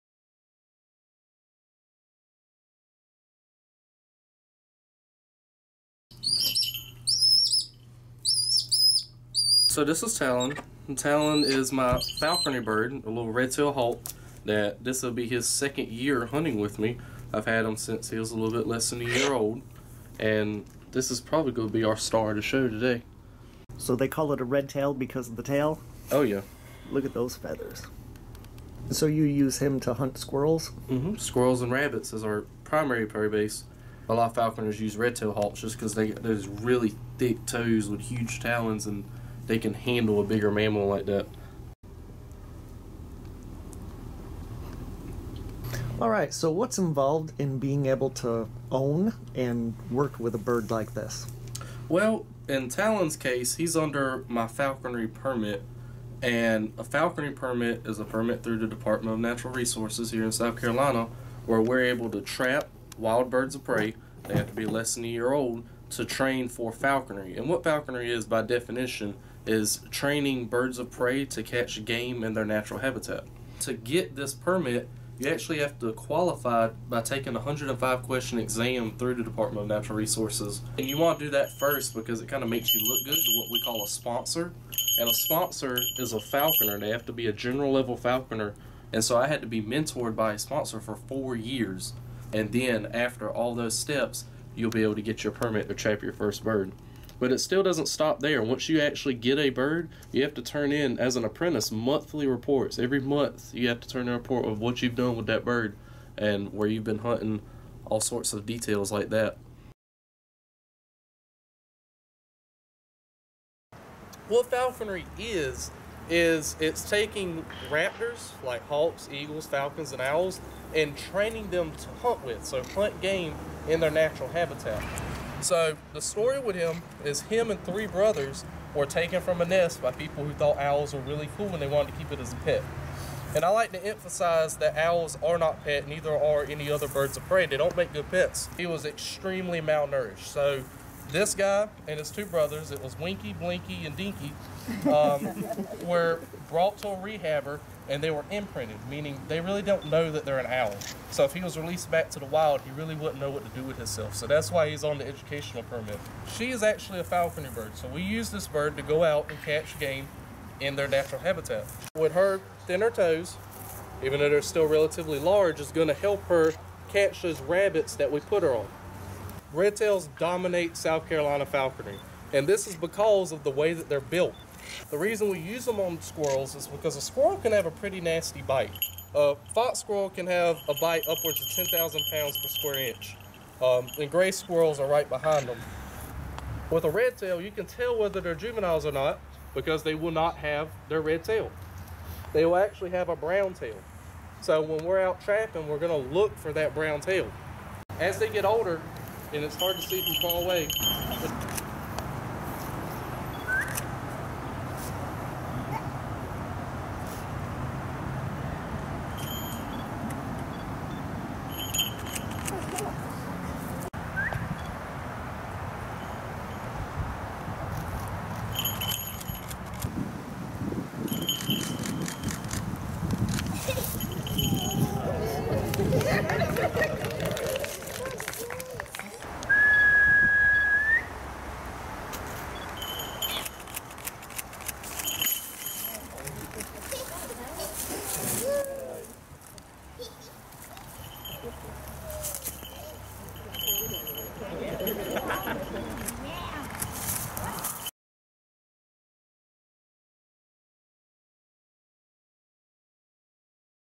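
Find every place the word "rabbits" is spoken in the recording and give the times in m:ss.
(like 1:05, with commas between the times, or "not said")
0:31, 2:47.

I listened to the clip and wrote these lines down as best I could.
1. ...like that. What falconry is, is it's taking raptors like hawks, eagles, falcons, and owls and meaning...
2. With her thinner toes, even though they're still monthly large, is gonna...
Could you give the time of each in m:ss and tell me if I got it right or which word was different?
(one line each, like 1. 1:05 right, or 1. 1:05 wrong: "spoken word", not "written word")
1. 1:48 wrong: "training", not "meaning"
2. 2:41 wrong: "relatively", not "monthly".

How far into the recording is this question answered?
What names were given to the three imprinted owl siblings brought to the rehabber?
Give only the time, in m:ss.
2:22.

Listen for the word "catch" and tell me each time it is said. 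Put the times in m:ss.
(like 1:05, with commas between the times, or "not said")
1:11, 2:39, 2:46.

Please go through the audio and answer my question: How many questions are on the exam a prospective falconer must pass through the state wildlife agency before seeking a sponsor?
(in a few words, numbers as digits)
105.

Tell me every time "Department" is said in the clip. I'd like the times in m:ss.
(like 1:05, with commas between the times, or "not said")
0:58, 1:19.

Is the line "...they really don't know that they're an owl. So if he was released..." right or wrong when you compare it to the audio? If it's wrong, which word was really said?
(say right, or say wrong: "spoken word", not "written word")
right.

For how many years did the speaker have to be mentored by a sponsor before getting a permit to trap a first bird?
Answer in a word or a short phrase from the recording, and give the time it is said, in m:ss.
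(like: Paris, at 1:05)
4, at 1:30.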